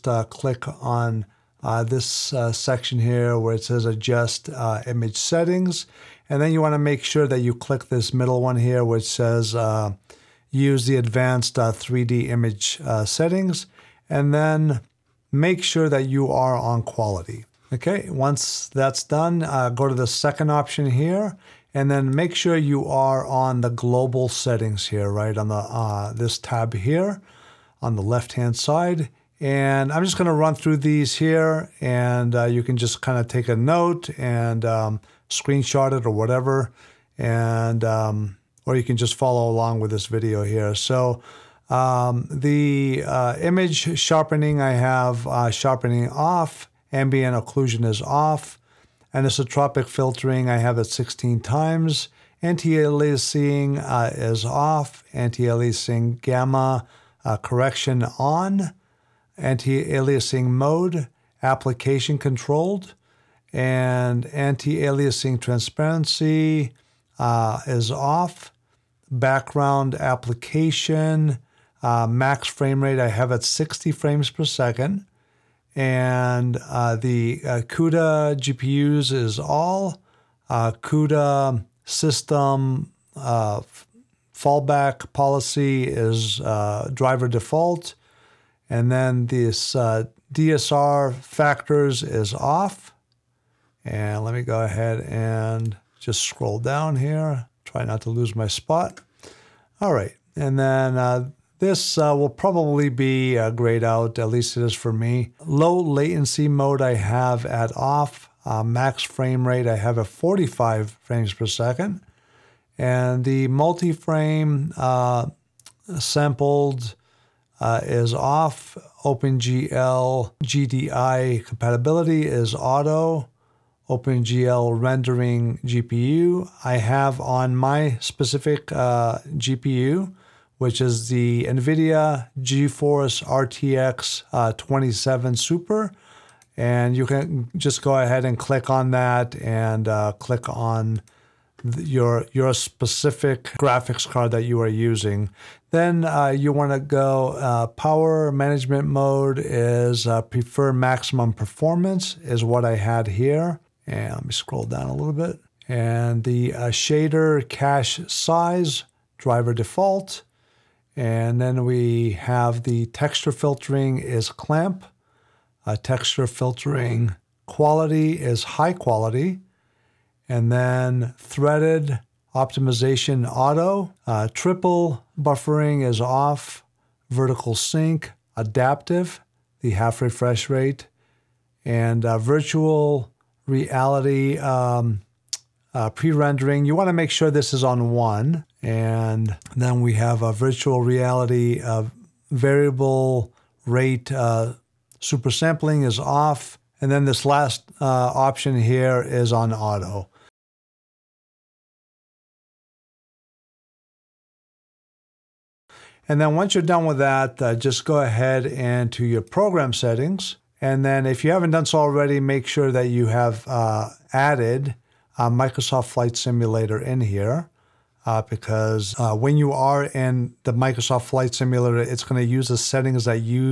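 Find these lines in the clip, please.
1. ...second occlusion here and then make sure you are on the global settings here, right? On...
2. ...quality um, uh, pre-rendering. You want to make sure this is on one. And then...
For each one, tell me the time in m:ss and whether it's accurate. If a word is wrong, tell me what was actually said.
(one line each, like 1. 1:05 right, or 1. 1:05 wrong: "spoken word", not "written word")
1. 0:20 wrong: "option", not "occlusion"
2. 3:03 wrong: "reality", not "quality".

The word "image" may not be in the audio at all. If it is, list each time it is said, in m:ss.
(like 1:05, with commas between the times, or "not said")
0:04, 0:12, 0:43.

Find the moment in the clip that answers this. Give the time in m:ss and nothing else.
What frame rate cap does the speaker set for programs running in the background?
1:13.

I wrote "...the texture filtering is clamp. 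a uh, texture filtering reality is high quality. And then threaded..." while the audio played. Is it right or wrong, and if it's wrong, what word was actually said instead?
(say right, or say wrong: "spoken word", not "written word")
wrong: "quality", not "reality".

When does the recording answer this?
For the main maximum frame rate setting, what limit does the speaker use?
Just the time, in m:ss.
1:50.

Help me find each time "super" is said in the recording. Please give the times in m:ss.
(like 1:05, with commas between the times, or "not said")
2:15, 3:14.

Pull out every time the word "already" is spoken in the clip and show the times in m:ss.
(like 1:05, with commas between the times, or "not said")
3:31.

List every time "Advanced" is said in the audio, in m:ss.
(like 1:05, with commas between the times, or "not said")
0:10.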